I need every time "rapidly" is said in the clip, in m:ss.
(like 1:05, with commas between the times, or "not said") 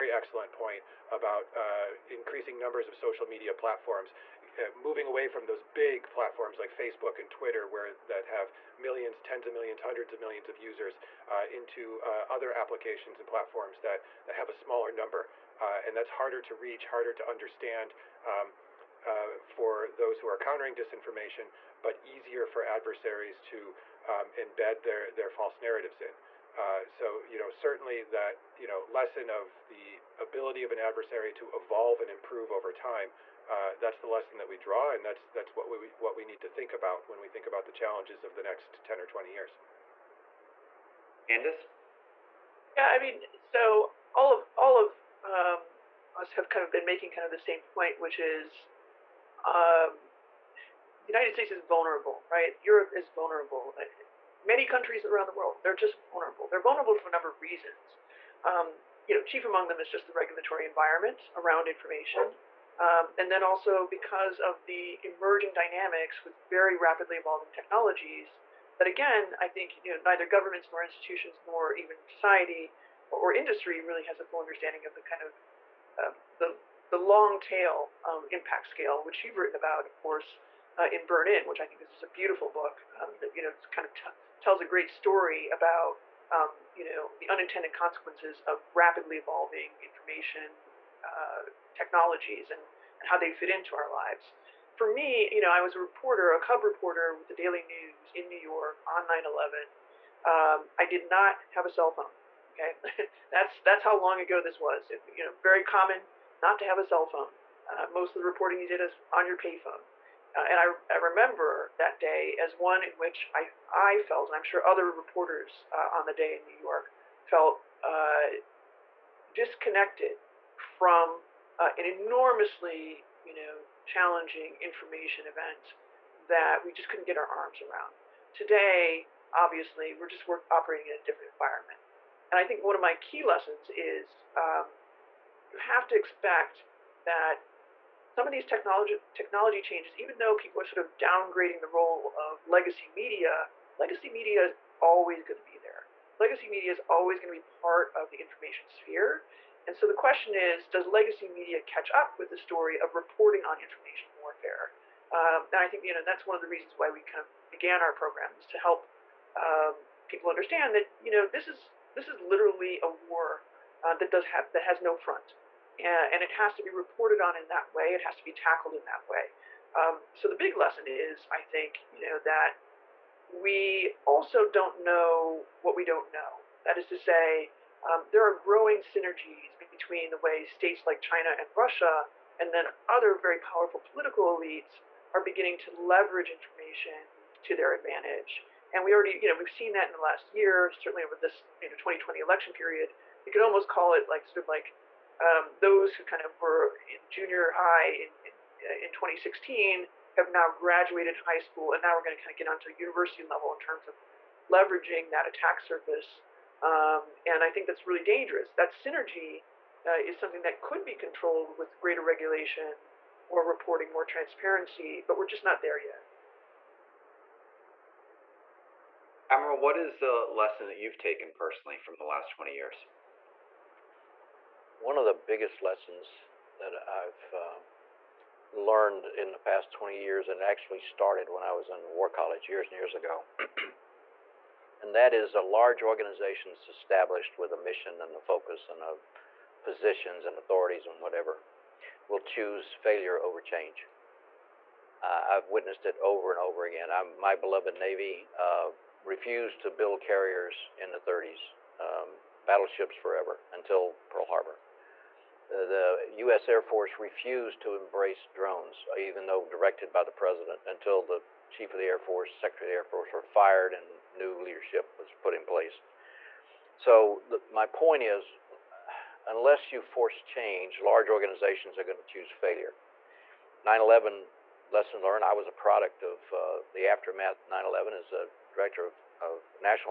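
1:06, 1:28.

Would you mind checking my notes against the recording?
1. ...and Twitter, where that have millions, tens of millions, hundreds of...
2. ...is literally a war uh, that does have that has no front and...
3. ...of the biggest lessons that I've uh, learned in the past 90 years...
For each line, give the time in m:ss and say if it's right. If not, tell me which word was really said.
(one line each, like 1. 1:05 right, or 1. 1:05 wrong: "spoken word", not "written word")
1. 0:07 right
2. 2:42 right
3. 3:44 wrong: "20", not "90".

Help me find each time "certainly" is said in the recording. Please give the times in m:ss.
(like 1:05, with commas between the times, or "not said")
0:27, 3:10.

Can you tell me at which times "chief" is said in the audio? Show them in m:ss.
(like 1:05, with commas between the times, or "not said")
0:59, 4:21.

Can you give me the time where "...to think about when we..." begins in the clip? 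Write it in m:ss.
0:36.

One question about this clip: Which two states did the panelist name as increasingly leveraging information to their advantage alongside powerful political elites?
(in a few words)
China and Russia.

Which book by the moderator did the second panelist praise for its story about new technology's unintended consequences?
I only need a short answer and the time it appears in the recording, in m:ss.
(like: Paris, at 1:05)
Burn In, at 1:21.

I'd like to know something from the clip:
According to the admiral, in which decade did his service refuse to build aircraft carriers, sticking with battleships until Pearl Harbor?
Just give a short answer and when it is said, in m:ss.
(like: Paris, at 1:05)
the 30s, at 4:10.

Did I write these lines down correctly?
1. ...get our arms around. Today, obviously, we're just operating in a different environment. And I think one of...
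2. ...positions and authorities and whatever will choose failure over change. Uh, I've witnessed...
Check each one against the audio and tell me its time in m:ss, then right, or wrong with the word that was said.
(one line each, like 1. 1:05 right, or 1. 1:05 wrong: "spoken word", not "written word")
1. 2:07 right
2. 3:59 right.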